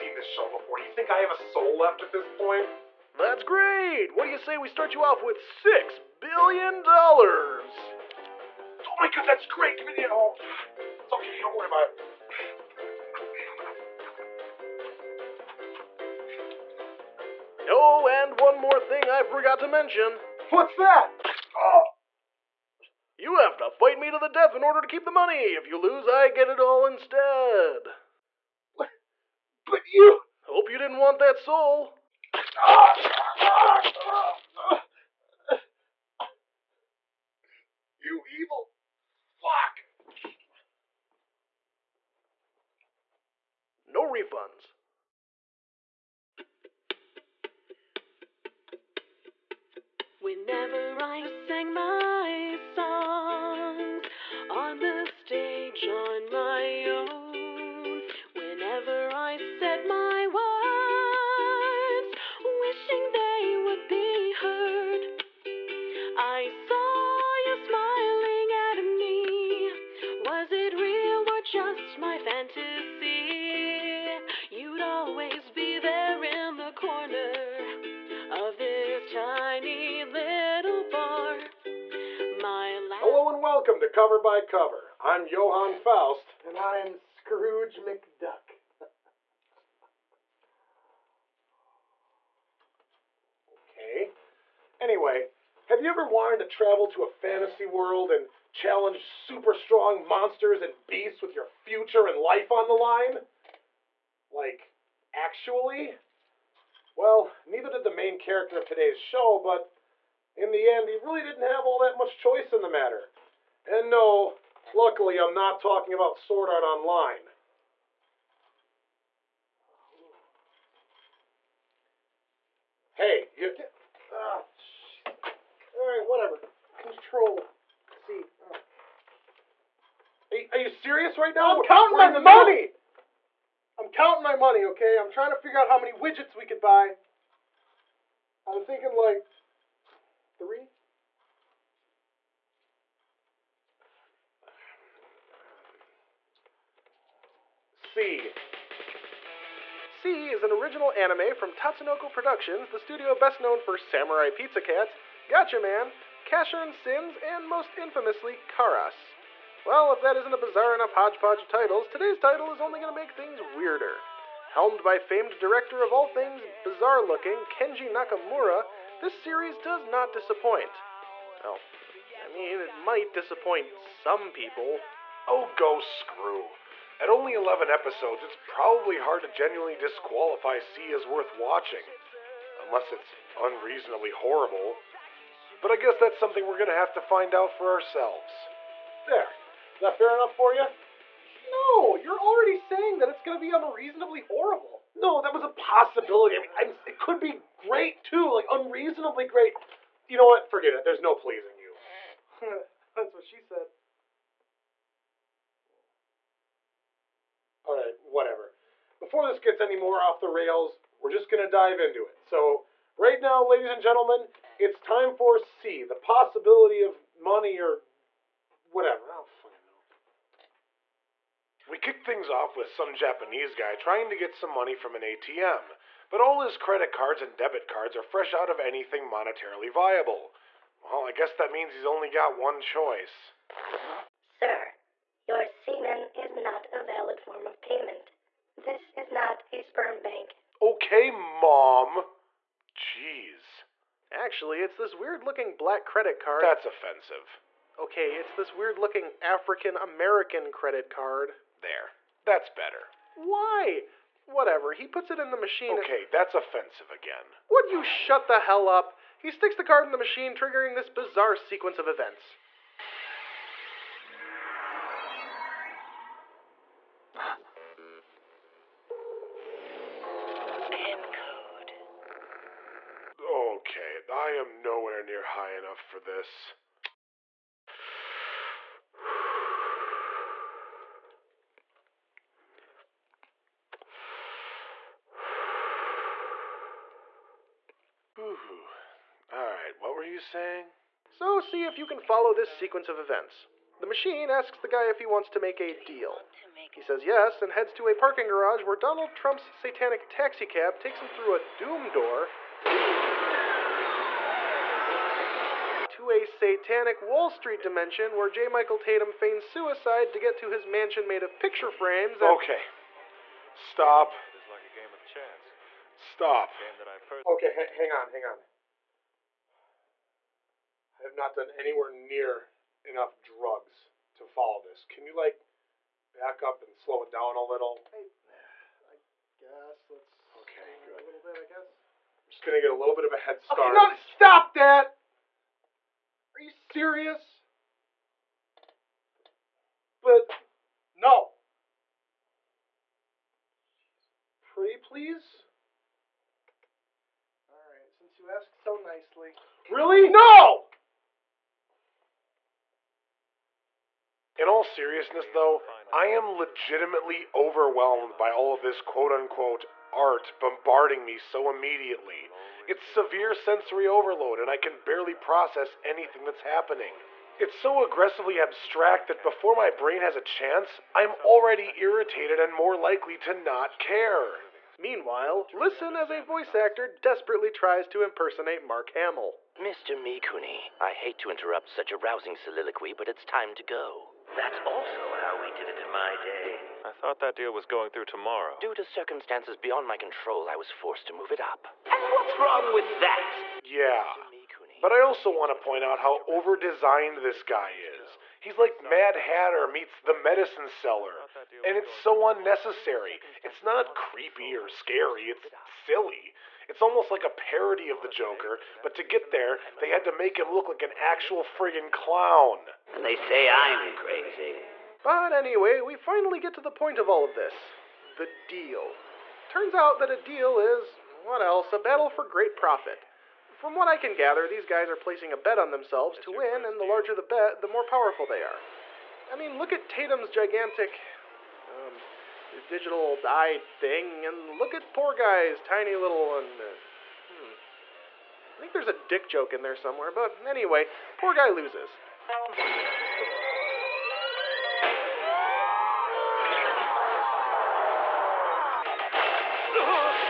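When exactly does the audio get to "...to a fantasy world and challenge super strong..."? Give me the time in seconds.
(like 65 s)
96 s.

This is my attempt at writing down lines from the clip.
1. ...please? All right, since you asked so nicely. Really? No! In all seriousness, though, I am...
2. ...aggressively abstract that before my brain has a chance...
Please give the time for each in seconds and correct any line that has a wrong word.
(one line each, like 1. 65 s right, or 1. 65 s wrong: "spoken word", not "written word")
1. 344 s right
2. 367 s right.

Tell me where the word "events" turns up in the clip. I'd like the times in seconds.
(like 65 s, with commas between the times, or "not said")
261 s, 292 s.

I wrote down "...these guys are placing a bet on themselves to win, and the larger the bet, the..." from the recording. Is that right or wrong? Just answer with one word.
right.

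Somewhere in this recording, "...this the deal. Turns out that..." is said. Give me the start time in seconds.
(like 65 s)
417 s.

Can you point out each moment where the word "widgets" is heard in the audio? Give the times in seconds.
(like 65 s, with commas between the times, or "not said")
135 s.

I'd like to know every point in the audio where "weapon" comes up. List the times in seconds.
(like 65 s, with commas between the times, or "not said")
not said.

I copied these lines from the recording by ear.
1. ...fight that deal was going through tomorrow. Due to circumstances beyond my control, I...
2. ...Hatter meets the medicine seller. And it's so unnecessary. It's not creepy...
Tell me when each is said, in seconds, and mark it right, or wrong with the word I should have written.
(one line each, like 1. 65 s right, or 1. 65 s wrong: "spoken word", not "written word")
1. 386 s wrong: "thought", not "fight"
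2. 399 s right.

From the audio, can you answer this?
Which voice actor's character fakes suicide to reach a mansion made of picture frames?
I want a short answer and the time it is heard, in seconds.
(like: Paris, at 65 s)
J. Michael Tatum, at 308 s.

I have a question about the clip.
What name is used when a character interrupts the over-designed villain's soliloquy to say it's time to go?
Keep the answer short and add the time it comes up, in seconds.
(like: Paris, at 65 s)
Mr. Mikuni, at 379 s.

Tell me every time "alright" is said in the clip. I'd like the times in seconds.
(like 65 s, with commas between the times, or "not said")
125 s, 289 s.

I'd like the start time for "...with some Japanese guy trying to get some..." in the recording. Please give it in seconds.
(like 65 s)
222 s.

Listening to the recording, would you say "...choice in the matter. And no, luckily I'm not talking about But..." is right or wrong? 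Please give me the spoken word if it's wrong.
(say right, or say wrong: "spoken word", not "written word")
wrong: "Sword", not "But".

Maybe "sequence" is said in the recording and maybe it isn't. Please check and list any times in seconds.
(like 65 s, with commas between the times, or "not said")
261 s, 292 s.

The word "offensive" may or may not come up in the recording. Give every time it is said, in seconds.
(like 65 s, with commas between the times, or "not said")
246 s, 256 s.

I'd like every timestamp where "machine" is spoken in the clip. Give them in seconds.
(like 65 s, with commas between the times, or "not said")
255 s, 259 s, 293 s.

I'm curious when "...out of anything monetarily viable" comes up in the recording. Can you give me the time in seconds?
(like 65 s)
228 s.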